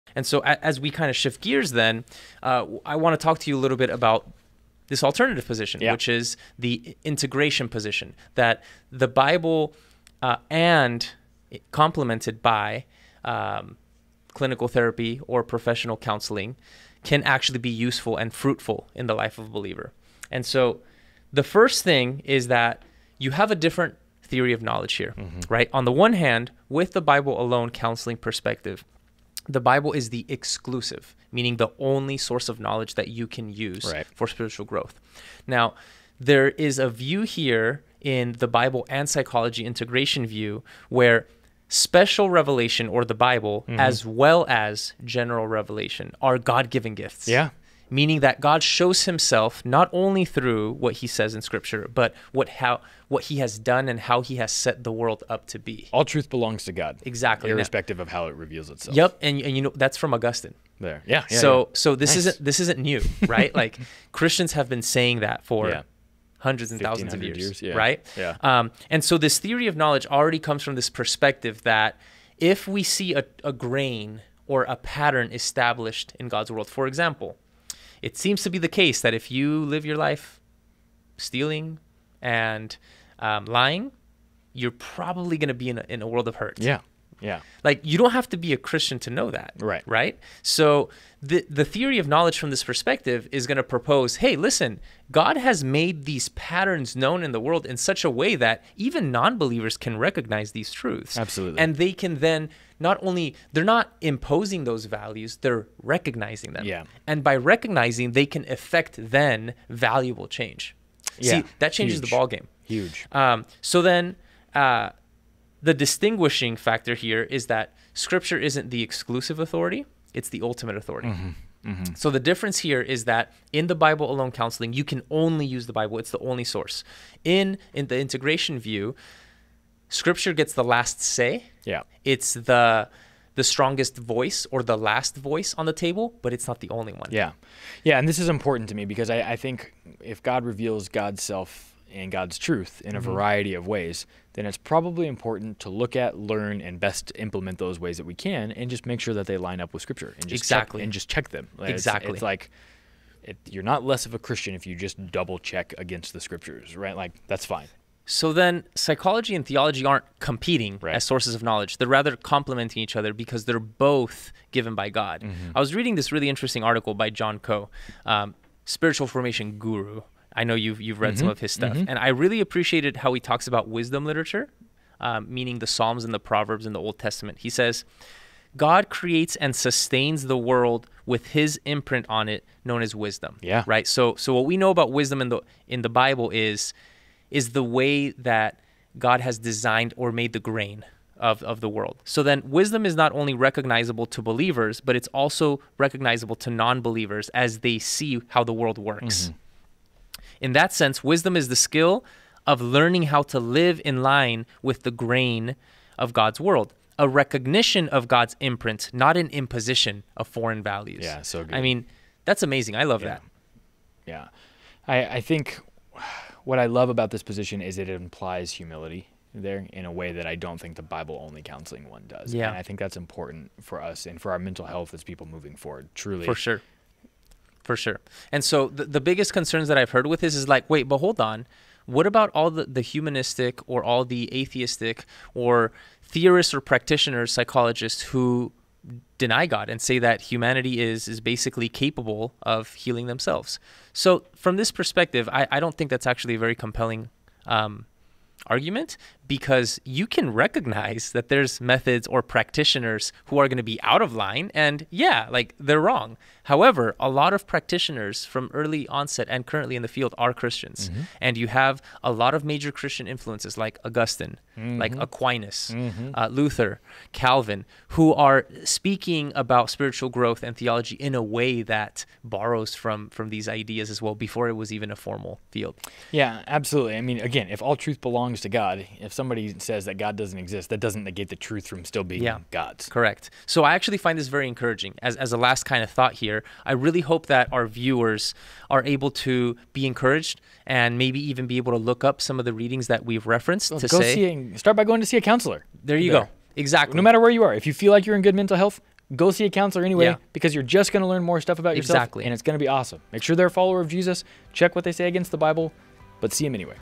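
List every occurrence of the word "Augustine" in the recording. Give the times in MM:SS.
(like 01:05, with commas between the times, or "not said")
01:00, 04:23.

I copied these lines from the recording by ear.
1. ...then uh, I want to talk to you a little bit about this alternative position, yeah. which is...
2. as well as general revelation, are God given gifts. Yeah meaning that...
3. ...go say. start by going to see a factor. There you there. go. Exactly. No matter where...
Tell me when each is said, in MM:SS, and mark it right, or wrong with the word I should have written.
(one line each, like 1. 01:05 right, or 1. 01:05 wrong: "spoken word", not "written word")
1. 00:01 right
2. 00:43 right
3. 04:53 wrong: "counselor", not "factor".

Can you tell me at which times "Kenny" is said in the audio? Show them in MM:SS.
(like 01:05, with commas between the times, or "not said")
not said.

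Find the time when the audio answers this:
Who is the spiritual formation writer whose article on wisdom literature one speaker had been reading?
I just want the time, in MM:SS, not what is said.
02:47.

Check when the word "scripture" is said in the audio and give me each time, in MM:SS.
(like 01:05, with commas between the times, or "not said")
00:51, 01:57, 02:09, 02:29, 02:36.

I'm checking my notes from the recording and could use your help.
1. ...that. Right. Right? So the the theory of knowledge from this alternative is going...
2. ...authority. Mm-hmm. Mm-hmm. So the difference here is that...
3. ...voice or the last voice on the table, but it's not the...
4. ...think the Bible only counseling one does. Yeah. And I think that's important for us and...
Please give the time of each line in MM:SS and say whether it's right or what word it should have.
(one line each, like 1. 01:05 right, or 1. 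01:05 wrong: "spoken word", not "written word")
1. 01:29 wrong: "perspective", not "alternative"
2. 02:00 right
3. 02:13 right
4. 03:40 right.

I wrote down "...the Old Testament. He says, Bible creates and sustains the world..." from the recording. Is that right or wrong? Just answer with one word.
wrong.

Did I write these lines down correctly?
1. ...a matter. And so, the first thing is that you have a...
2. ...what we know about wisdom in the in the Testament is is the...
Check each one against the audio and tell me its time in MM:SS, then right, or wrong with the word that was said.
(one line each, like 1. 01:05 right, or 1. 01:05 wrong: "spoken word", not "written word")
1. 00:19 wrong: "believer", not "matter"
2. 03:04 wrong: "Bible", not "Testament".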